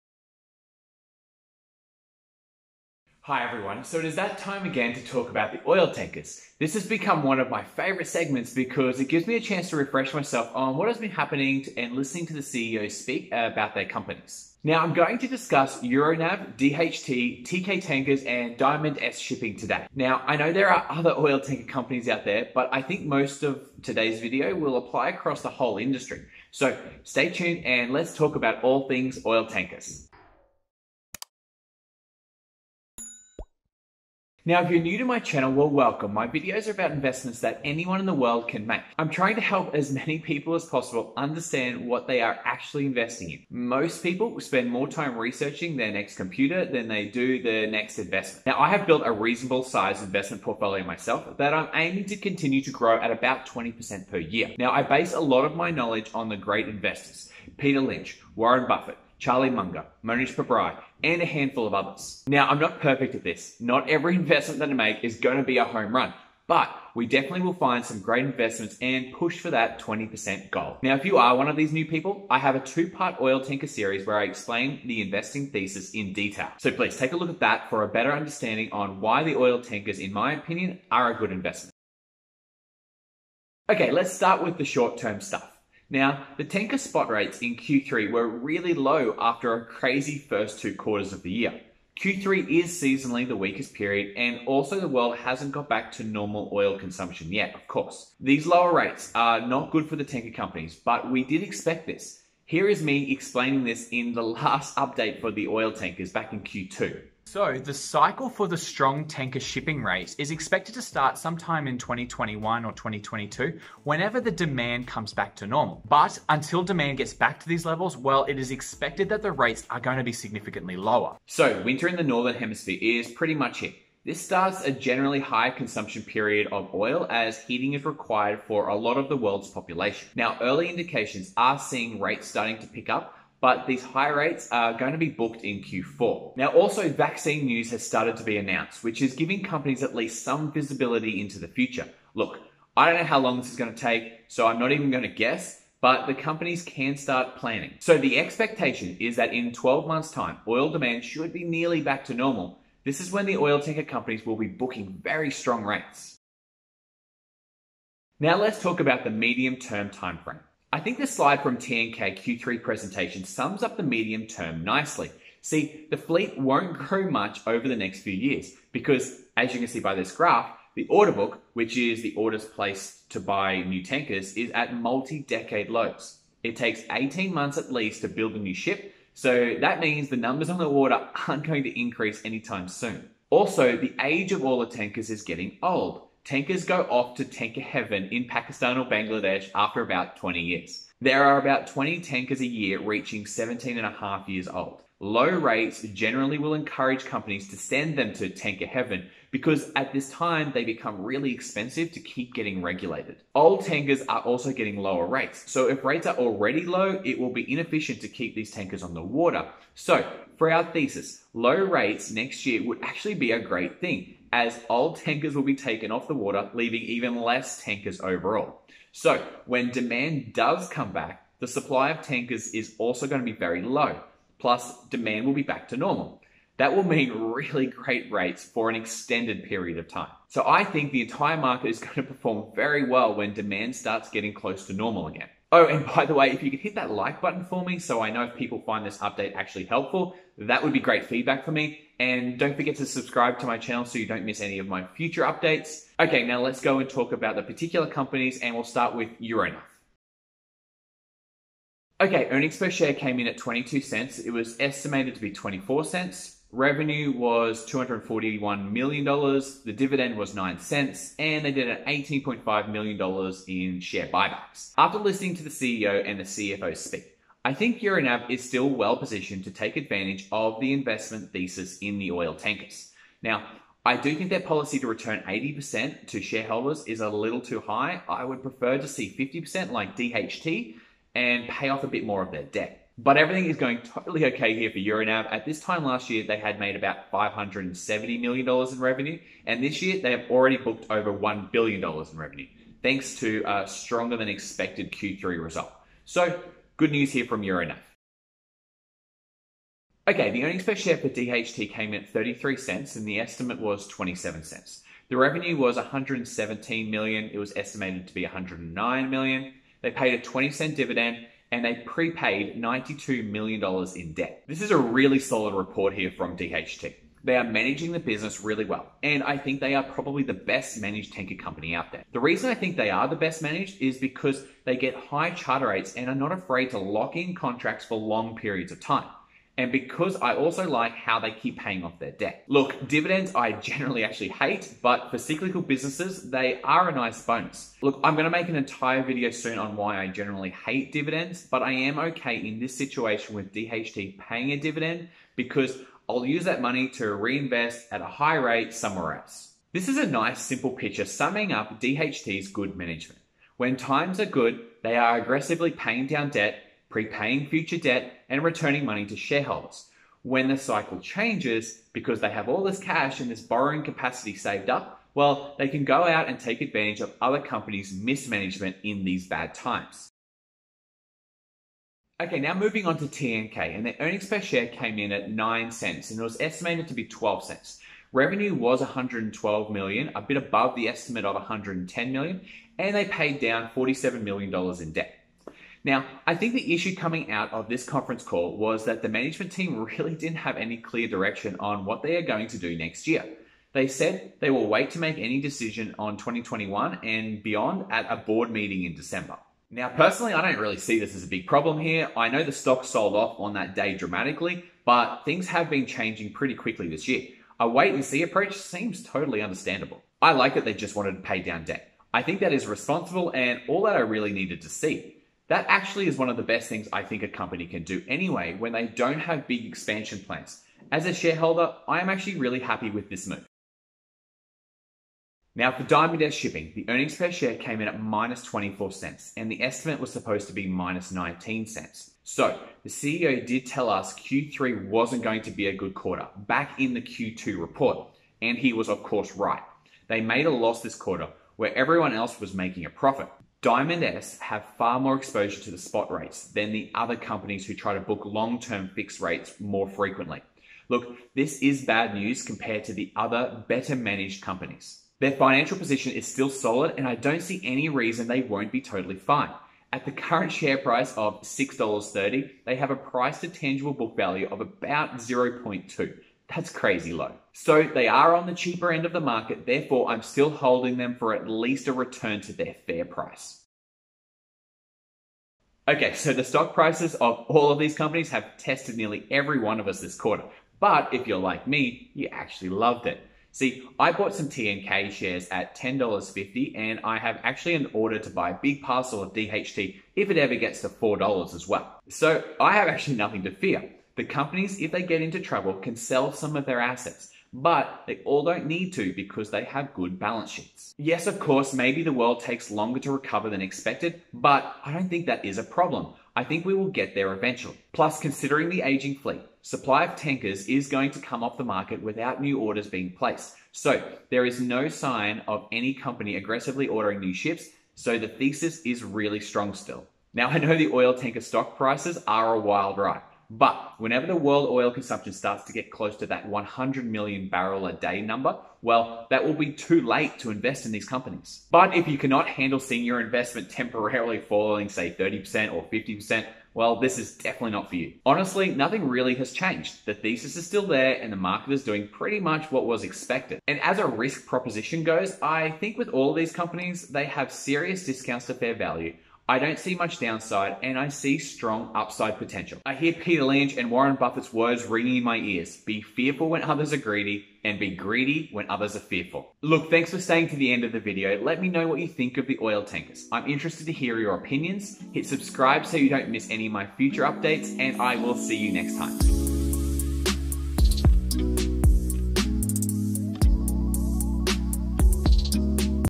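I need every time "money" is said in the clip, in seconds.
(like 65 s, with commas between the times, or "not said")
346 s, 358 s.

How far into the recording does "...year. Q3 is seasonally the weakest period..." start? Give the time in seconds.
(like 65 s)
91 s.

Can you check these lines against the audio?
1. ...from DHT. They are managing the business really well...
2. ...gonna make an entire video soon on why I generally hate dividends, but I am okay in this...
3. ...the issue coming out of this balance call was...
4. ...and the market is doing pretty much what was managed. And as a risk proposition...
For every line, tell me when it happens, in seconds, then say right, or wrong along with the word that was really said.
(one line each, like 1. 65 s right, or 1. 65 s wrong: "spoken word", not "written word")
1. 316 s right
2. 338 s right
3. 386 s wrong: "conference", not "balance"
4. 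541 s wrong: "expected", not "managed".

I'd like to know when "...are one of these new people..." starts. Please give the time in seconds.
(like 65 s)
71 s.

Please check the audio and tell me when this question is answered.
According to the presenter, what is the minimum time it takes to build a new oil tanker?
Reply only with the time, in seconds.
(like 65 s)
176 s.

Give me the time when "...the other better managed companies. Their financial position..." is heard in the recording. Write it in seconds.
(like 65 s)
452 s.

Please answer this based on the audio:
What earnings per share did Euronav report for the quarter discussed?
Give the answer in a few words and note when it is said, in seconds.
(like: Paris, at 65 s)
22 cents, at 253 s.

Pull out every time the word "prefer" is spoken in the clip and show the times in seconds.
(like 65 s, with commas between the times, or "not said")
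278 s.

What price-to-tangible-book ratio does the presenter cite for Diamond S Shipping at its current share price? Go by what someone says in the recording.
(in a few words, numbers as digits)
0.2.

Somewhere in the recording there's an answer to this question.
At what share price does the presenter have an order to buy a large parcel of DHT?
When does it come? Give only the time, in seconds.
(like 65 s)
490 s.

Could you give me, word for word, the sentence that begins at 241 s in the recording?
And don't forget to subscribe to my channel so you don't miss any of my future updates.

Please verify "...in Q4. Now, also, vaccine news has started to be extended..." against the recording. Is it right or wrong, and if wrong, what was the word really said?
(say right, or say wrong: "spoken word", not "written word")
wrong: "announced", not "extended".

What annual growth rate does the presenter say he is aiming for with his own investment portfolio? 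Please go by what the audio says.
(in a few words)
20%.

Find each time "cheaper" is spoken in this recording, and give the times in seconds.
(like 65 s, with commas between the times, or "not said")
468 s.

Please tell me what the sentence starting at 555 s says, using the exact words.
Be fearful when others are greedy and be greedy when others are fearful.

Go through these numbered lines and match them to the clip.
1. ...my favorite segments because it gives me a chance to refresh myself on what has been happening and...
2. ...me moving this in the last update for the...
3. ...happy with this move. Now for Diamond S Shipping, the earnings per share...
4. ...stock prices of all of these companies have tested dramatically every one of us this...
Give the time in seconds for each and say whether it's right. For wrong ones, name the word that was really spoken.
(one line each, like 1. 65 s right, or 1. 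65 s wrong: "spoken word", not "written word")
1. 7 s right
2. 102 s wrong: "explaining", not "moving"
3. 422 s right
4. 476 s wrong: "nearly", not "dramatically".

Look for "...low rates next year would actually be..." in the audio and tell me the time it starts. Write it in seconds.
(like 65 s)
211 s.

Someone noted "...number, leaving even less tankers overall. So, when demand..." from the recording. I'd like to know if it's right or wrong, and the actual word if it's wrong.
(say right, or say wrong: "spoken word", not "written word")
wrong: "water", not "number".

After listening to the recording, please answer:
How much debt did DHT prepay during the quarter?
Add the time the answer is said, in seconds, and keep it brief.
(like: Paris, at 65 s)
$92 million, at 312 s.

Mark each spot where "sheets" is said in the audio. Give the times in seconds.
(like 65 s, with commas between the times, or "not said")
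500 s.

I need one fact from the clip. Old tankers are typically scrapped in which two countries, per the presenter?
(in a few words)
Pakistan or Bangladesh.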